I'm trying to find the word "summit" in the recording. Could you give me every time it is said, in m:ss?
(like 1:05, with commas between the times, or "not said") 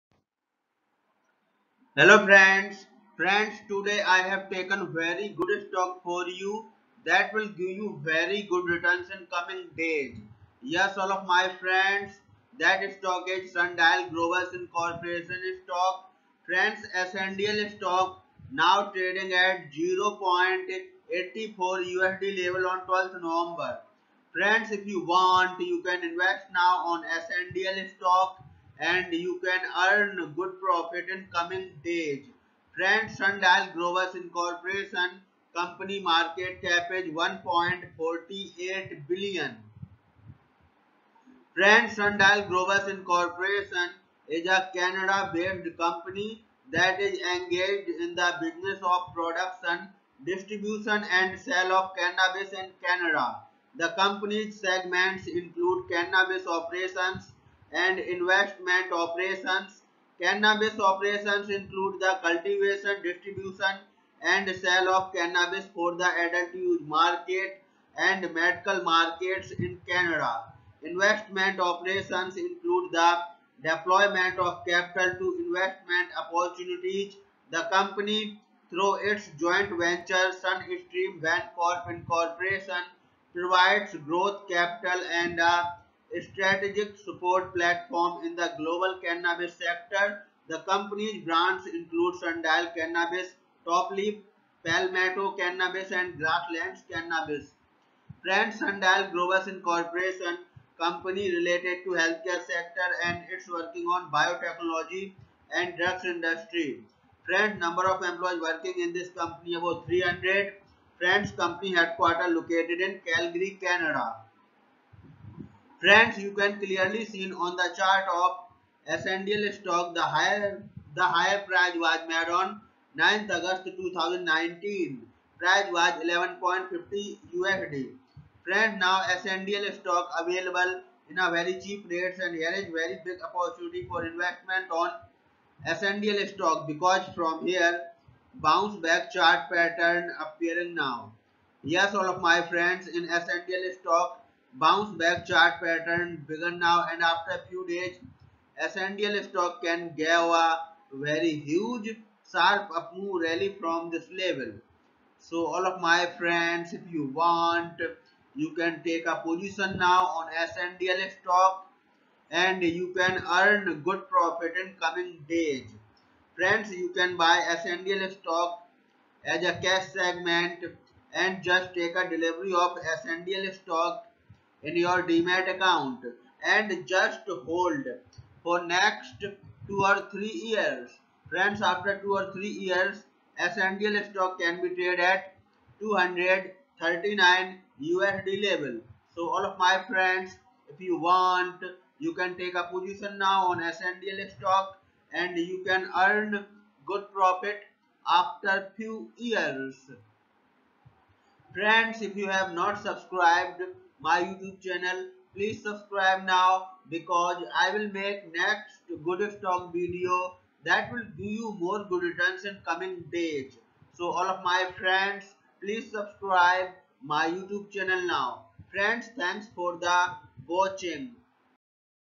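not said.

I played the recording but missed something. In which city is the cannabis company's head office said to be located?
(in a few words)
Calgary.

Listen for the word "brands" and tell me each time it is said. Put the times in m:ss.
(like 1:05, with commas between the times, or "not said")
1:31, 1:38.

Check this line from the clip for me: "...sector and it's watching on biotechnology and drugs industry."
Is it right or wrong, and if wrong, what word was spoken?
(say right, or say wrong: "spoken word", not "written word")
wrong: "working", not "watching".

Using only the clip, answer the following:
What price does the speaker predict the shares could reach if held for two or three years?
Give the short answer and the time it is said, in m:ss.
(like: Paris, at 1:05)
239 USD, at 3:05.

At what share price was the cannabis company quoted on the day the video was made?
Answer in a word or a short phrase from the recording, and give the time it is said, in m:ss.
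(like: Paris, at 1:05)
0.84 USD, at 0:19.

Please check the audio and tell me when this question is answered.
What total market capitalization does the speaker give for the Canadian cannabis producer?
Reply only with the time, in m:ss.
0:37.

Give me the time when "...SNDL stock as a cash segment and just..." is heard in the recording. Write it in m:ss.
2:47.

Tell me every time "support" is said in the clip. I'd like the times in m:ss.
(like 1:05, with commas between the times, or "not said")
1:26.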